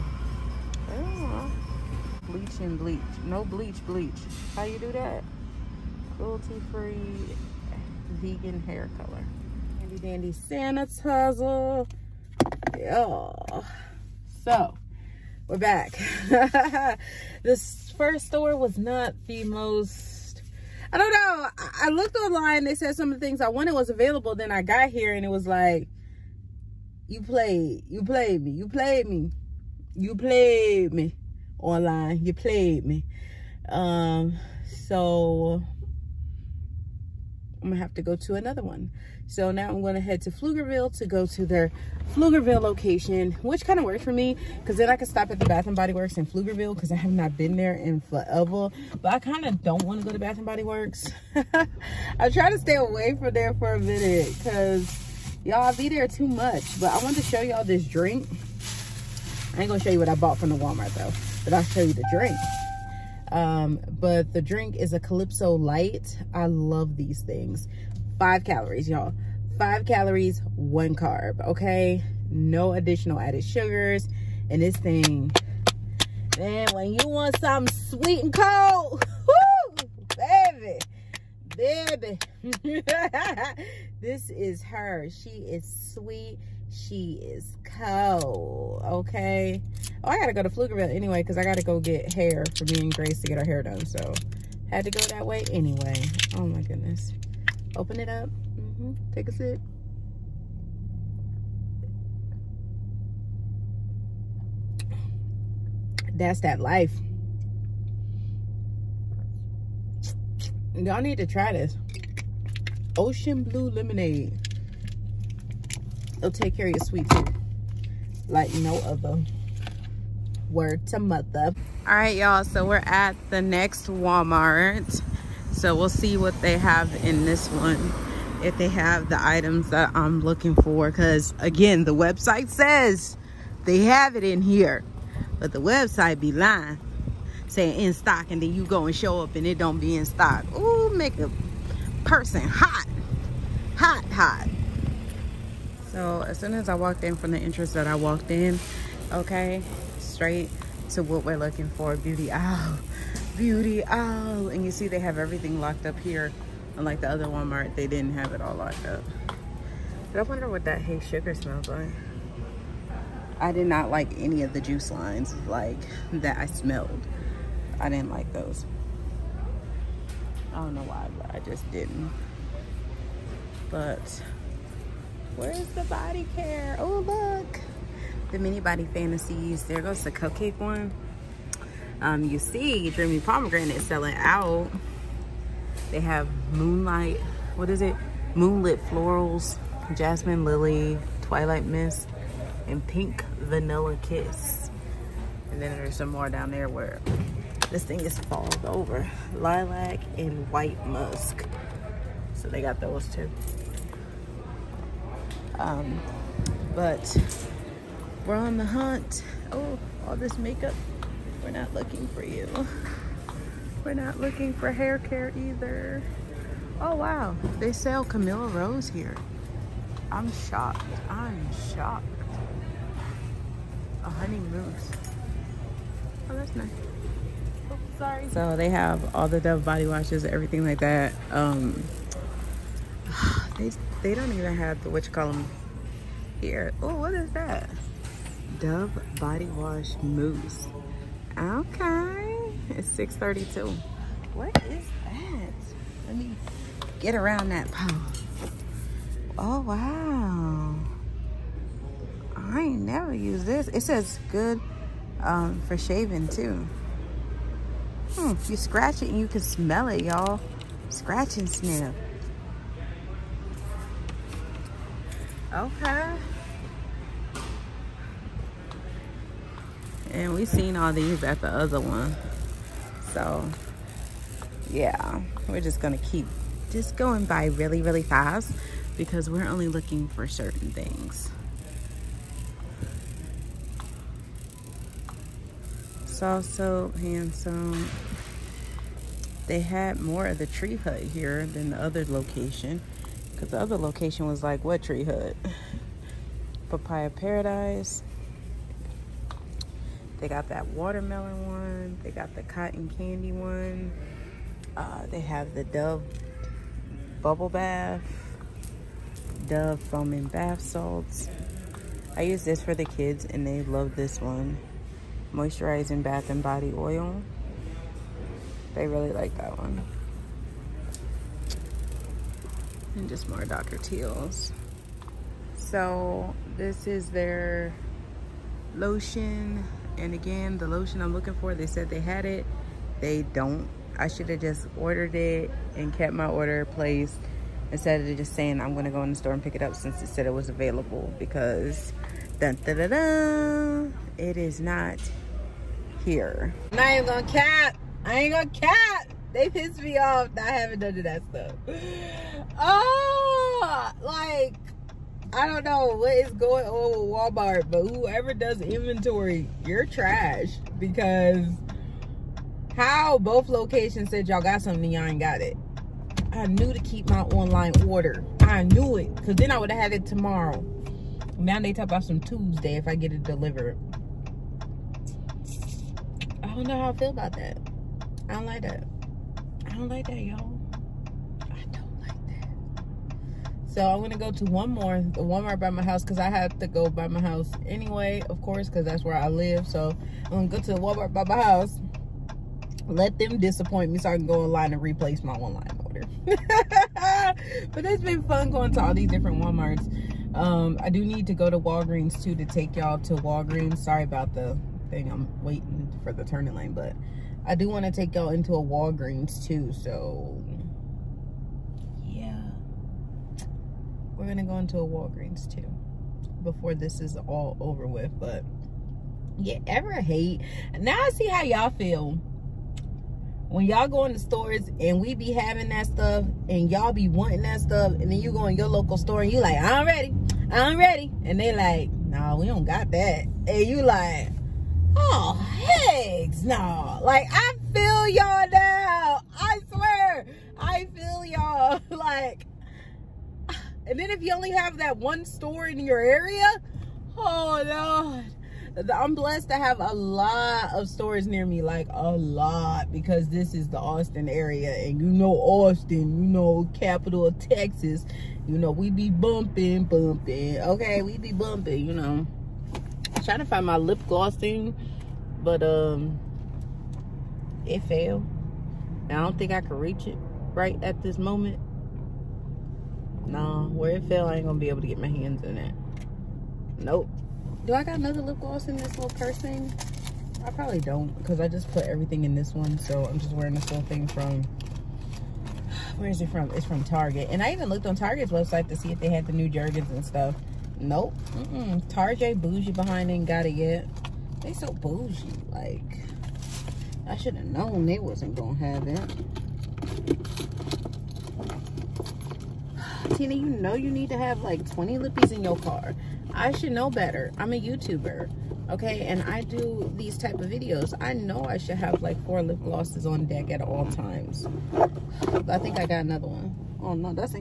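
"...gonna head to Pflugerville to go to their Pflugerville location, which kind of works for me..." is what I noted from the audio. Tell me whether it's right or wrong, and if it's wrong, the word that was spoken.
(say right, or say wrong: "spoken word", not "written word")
right.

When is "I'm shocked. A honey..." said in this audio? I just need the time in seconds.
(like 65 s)
221 s.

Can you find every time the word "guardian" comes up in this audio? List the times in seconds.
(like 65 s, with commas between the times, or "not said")
not said.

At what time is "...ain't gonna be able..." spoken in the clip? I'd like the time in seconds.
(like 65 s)
474 s.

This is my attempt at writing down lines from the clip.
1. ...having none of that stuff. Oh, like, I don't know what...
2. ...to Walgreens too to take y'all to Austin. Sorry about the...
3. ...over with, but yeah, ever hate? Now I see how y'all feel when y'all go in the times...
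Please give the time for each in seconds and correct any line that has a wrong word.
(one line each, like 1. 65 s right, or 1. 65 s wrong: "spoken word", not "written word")
1. 350 s right
2. 401 s wrong: "Walgreens", not "Austin"
3. 417 s wrong: "stores", not "times".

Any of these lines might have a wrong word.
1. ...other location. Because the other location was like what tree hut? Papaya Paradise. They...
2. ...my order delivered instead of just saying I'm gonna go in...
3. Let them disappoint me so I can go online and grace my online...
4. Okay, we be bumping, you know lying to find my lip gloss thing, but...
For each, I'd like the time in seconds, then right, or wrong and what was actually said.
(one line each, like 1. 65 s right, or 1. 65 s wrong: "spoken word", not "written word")
1. 291 s right
2. 336 s wrong: "placed", not "delivered"
3. 392 s wrong: "replace", not "grace"
4. 460 s wrong: "trying", not "lying".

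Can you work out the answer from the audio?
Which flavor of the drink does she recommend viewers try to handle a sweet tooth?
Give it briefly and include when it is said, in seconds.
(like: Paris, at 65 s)
ocean blue lemonade, at 112 s.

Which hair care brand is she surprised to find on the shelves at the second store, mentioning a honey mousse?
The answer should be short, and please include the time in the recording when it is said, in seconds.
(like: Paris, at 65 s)
Camille Rose, at 218 s.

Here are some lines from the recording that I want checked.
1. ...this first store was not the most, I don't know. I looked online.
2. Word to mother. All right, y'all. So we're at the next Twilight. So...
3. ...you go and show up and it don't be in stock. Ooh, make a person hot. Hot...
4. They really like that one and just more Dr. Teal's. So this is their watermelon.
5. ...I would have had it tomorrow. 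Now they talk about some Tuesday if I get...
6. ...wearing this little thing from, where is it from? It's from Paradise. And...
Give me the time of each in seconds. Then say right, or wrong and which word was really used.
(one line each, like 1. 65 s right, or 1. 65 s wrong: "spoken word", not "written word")
1. 17 s right
2. 120 s wrong: "Walmart", not "Twilight"
3. 138 s right
4. 318 s wrong: "lotion", not "watermelon"
5. 369 s right
6. 483 s wrong: "Target", not "Paradise".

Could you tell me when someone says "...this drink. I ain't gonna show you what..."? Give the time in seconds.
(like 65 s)
57 s.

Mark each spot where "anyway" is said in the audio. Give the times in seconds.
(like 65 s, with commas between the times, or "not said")
90 s, 95 s, 387 s.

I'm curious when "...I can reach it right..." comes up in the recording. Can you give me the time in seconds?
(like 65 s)
469 s.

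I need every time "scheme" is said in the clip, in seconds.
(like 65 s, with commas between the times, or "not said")
not said.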